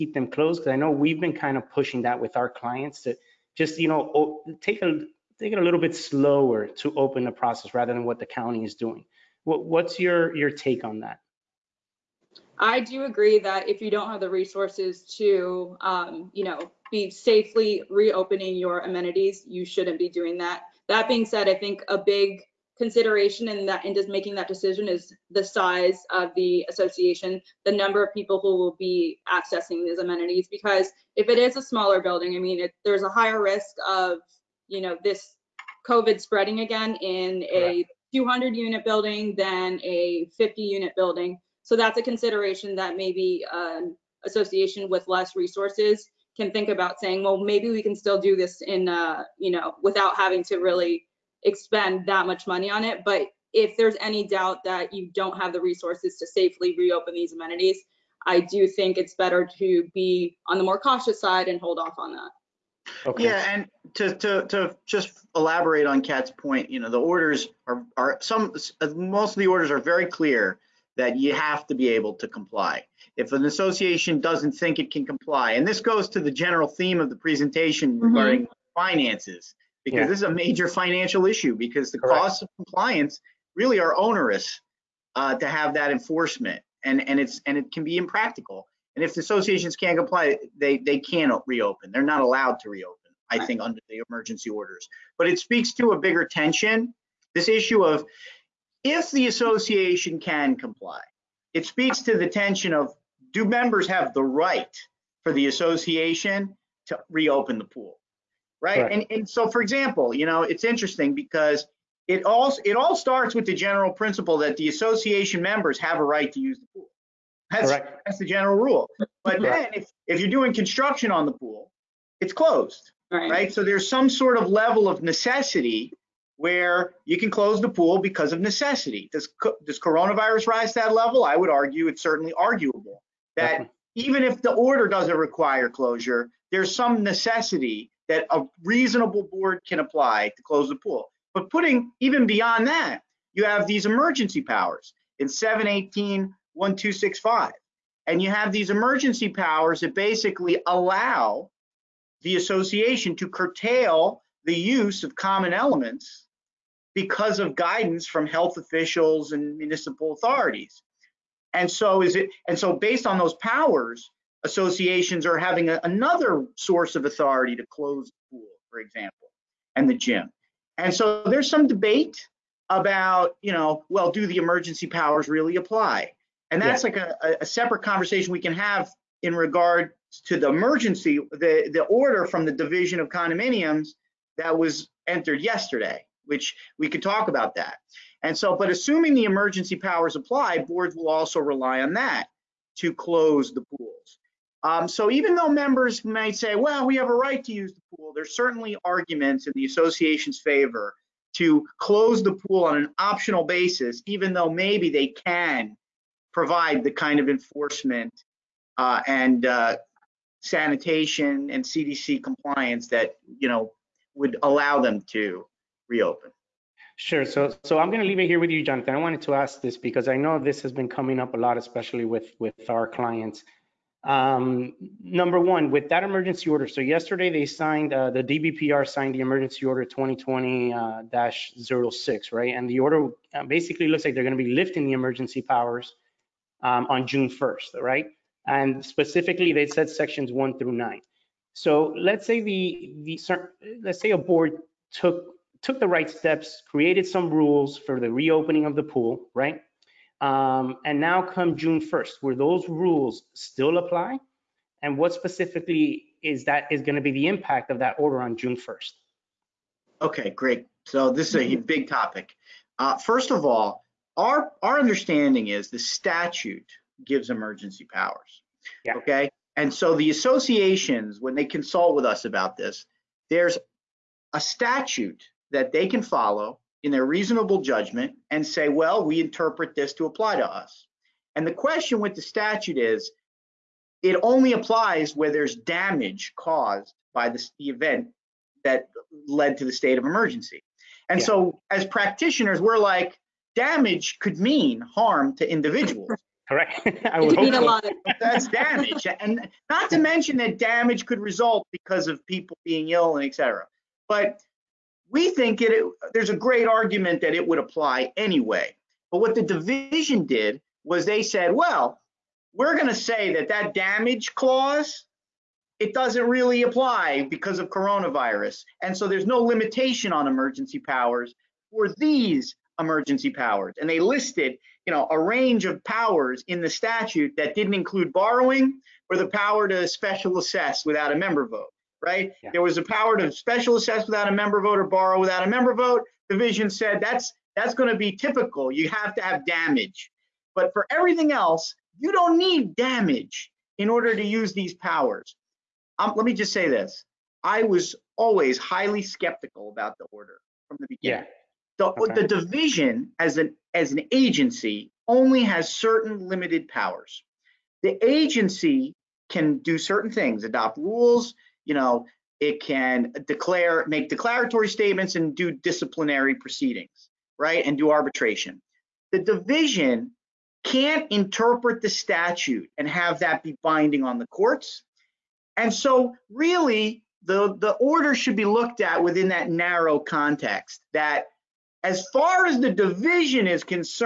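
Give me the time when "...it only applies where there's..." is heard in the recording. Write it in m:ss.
4:44.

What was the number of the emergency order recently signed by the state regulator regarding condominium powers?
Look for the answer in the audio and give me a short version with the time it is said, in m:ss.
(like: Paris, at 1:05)
2020-06, at 3:49.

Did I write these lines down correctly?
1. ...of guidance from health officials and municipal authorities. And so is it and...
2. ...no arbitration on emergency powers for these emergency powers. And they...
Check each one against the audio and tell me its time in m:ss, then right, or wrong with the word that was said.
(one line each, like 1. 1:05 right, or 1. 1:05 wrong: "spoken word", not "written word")
1. 2:37 right
2. 5:19 wrong: "limitation", not "arbitration".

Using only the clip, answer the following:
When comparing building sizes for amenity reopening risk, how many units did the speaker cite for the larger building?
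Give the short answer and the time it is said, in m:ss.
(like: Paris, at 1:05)
200, at 0:38.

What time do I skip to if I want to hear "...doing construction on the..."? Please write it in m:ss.
2:00.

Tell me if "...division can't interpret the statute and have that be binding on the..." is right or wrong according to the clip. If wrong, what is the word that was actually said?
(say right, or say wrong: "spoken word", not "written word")
right.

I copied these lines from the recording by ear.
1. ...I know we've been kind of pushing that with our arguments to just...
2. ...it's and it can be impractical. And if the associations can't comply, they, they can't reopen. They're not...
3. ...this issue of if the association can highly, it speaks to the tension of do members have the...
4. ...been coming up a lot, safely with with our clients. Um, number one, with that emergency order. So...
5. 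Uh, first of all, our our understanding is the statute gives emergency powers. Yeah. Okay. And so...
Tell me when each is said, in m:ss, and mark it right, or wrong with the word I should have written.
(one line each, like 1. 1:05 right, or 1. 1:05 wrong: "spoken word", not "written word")
1. 0:00 wrong: "clients", not "arguments"
2. 1:27 right
3. 1:37 wrong: "comply", not "highly"
4. 3:40 wrong: "especially", not "safely"
5. 4:22 right.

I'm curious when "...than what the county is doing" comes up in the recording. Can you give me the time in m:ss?
0:07.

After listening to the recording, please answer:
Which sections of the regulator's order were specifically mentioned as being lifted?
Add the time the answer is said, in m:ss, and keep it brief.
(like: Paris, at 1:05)
Sections 1 through 9, at 3:59.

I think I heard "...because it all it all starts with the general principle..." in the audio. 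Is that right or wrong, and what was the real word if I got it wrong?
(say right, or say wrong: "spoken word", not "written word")
right.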